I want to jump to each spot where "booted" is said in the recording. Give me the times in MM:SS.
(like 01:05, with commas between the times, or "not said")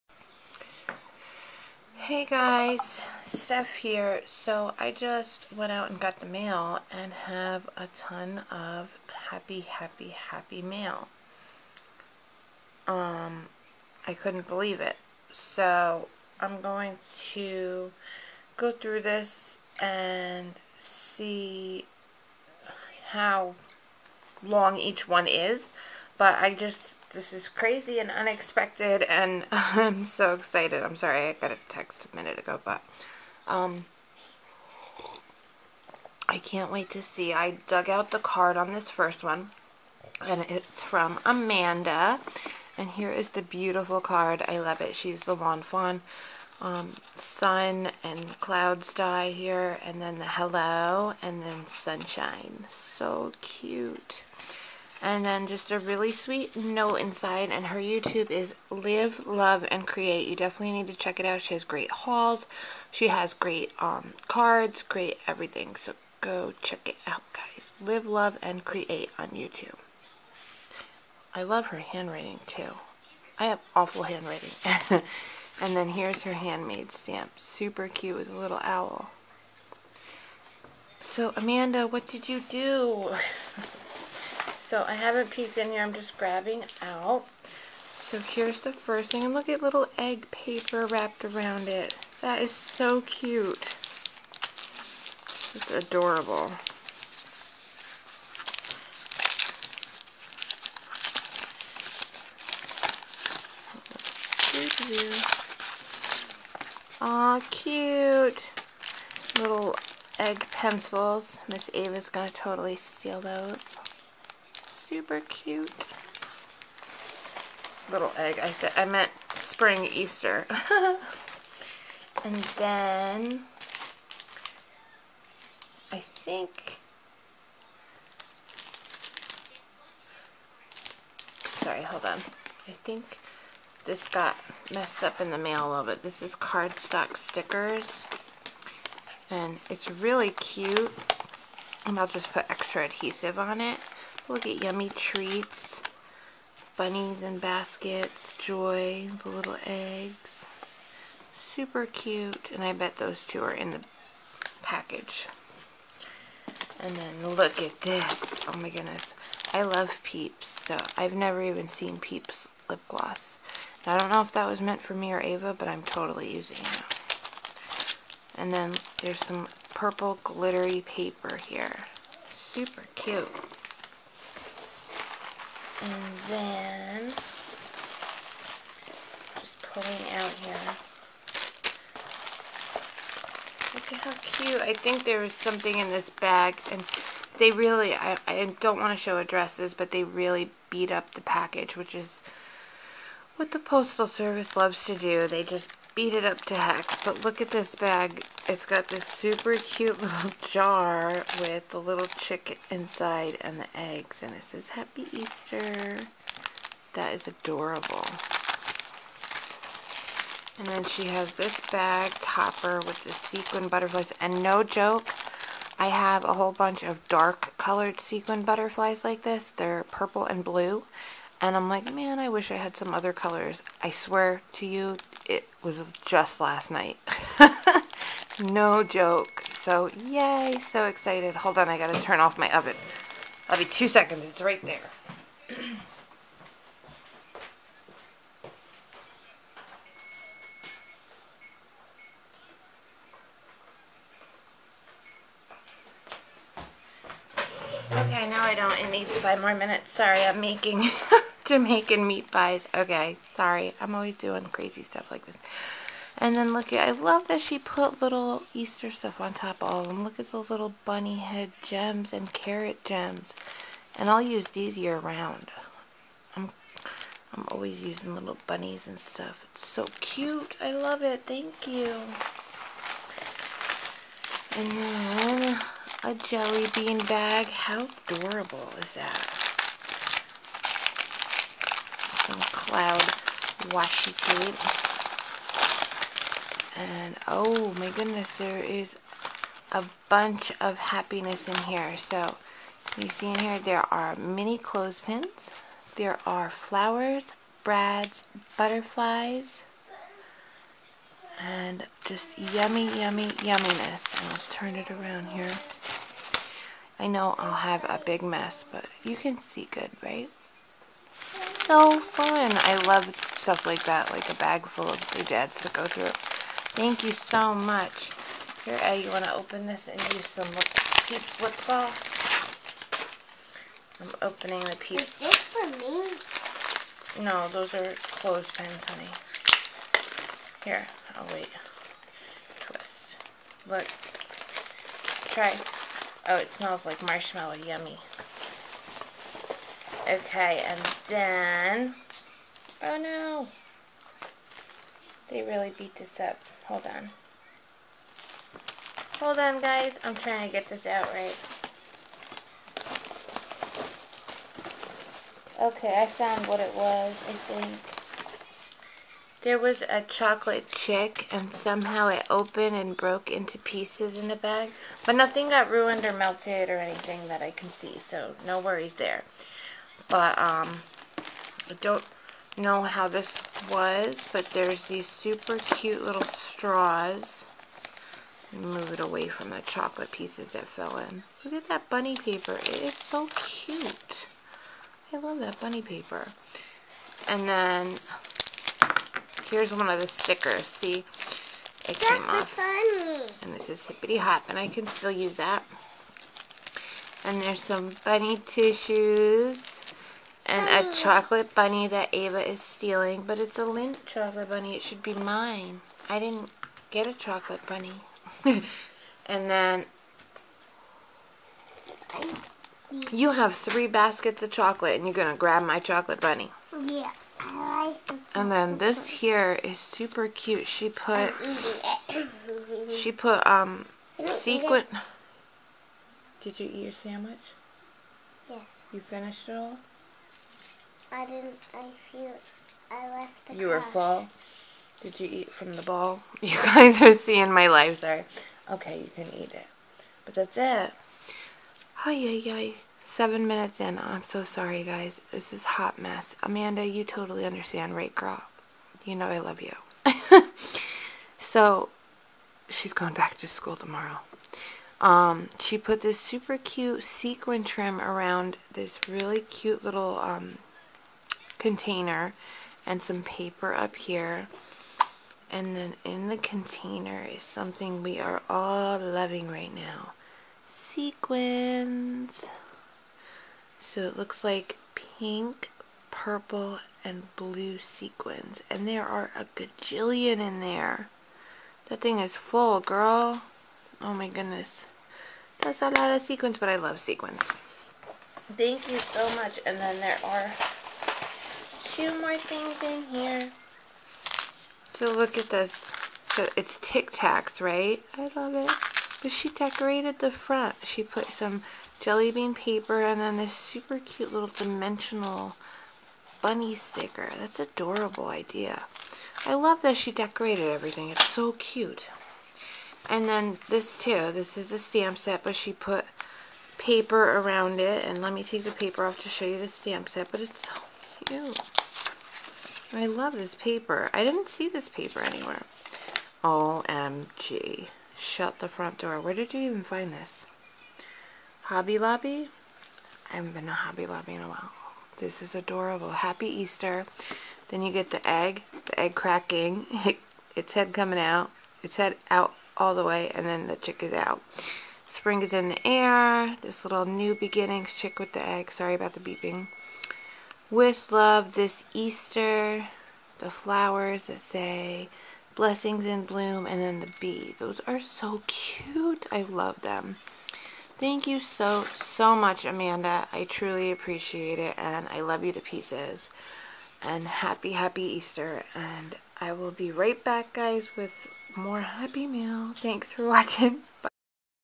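not said.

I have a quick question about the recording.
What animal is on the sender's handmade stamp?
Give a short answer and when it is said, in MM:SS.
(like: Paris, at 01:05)
Owl, at 01:18.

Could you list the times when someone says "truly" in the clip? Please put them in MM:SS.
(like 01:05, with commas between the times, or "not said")
09:23.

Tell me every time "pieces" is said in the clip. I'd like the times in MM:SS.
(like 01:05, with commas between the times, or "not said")
06:03, 06:20, 09:25.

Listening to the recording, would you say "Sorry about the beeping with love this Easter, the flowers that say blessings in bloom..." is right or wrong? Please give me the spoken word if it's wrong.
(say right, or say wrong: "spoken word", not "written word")
right.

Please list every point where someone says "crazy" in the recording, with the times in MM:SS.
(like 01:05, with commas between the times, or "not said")
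00:27, 04:14.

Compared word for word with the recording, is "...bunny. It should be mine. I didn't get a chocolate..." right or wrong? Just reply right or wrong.
right.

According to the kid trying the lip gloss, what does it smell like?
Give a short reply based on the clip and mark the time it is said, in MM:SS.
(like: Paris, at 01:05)
Marshmallow, at 05:37.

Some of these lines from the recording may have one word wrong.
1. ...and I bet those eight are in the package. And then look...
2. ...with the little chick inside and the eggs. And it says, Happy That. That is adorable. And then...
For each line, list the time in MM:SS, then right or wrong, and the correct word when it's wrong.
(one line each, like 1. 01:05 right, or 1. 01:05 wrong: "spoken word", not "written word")
1. 02:32 wrong: "two", not "eight"
2. 03:21 wrong: "Easter", not "That".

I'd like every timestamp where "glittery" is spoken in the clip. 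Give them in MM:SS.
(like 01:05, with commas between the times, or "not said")
02:50.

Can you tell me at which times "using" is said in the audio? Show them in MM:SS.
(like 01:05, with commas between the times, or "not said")
02:46, 04:27.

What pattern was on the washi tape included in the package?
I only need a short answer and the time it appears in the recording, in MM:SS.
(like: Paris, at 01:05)
Cloud, at 04:42.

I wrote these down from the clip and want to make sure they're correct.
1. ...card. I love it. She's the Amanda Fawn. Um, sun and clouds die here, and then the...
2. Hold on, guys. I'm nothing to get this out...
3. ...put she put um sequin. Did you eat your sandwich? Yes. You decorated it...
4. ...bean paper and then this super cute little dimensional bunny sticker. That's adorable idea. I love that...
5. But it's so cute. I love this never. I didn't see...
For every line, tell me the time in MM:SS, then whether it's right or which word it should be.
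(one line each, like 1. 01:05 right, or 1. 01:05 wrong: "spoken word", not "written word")
1. 00:43 wrong: "Lawn", not "Amanda"
2. 05:49 wrong: "trying", not "nothing"
3. 07:00 wrong: "finished", not "decorated"
4. 08:22 right
5. 08:40 wrong: "paper", not "never".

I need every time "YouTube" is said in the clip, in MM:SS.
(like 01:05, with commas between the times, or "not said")
00:57, 01:09.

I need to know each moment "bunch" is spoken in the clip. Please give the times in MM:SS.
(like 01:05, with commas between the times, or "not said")
03:36, 04:50.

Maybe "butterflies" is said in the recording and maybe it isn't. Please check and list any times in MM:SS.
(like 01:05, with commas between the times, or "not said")
03:33, 03:38, 04:58.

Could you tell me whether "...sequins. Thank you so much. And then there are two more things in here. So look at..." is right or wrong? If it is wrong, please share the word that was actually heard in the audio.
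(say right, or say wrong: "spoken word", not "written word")
right.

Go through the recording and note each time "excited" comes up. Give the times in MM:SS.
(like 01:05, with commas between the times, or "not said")
00:30.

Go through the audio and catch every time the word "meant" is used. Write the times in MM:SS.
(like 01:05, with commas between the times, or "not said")
01:58, 02:44.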